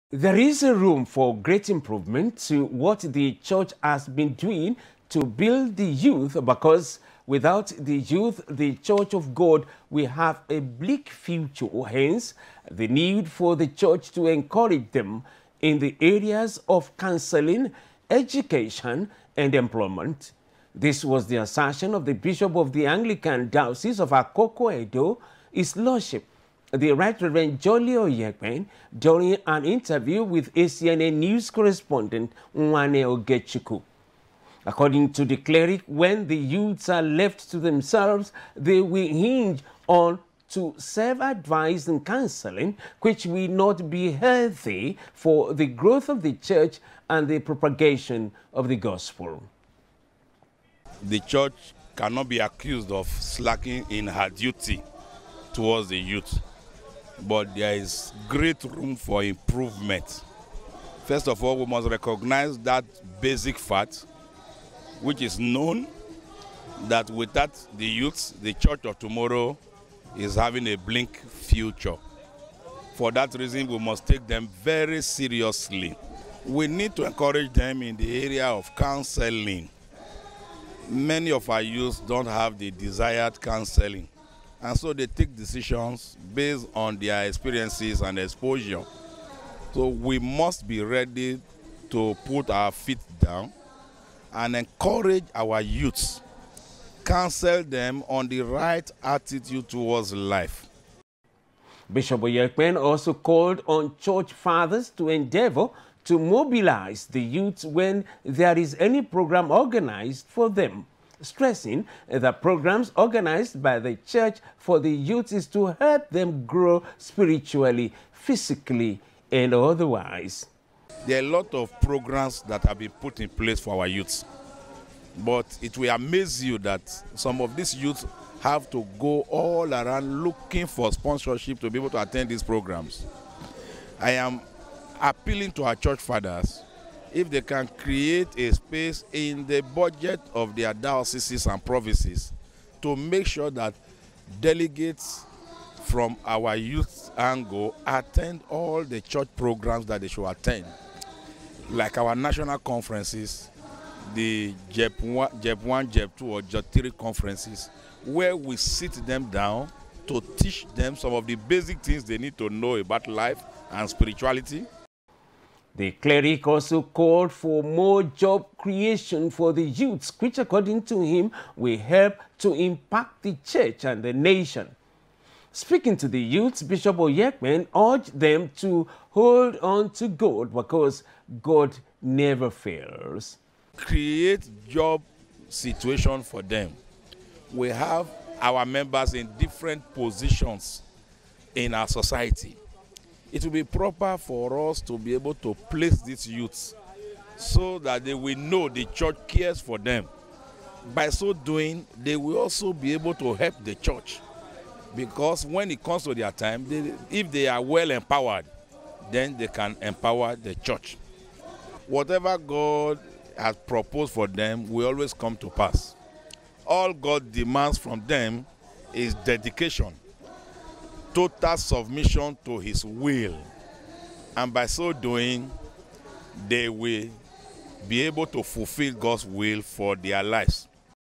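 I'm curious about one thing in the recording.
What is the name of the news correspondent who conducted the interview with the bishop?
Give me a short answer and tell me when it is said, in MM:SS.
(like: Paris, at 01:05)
Mwane Ogechiku, at 00:32.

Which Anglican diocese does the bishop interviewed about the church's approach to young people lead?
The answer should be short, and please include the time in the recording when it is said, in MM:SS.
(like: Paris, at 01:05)
Akoko Edo, at 00:24.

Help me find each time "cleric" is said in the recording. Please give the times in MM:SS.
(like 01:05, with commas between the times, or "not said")
00:35, 02:45.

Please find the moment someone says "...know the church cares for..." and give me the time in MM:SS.
03:18.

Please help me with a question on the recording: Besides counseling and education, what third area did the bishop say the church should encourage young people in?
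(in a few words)
employment.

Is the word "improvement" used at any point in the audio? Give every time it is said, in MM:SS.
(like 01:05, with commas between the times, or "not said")
00:01, 00:59.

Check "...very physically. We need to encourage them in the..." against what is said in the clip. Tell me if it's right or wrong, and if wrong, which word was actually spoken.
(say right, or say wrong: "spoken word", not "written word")
wrong: "seriously", not "physically".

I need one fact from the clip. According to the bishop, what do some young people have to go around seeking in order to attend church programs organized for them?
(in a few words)
sponsorship.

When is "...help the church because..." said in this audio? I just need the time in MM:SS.
03:23.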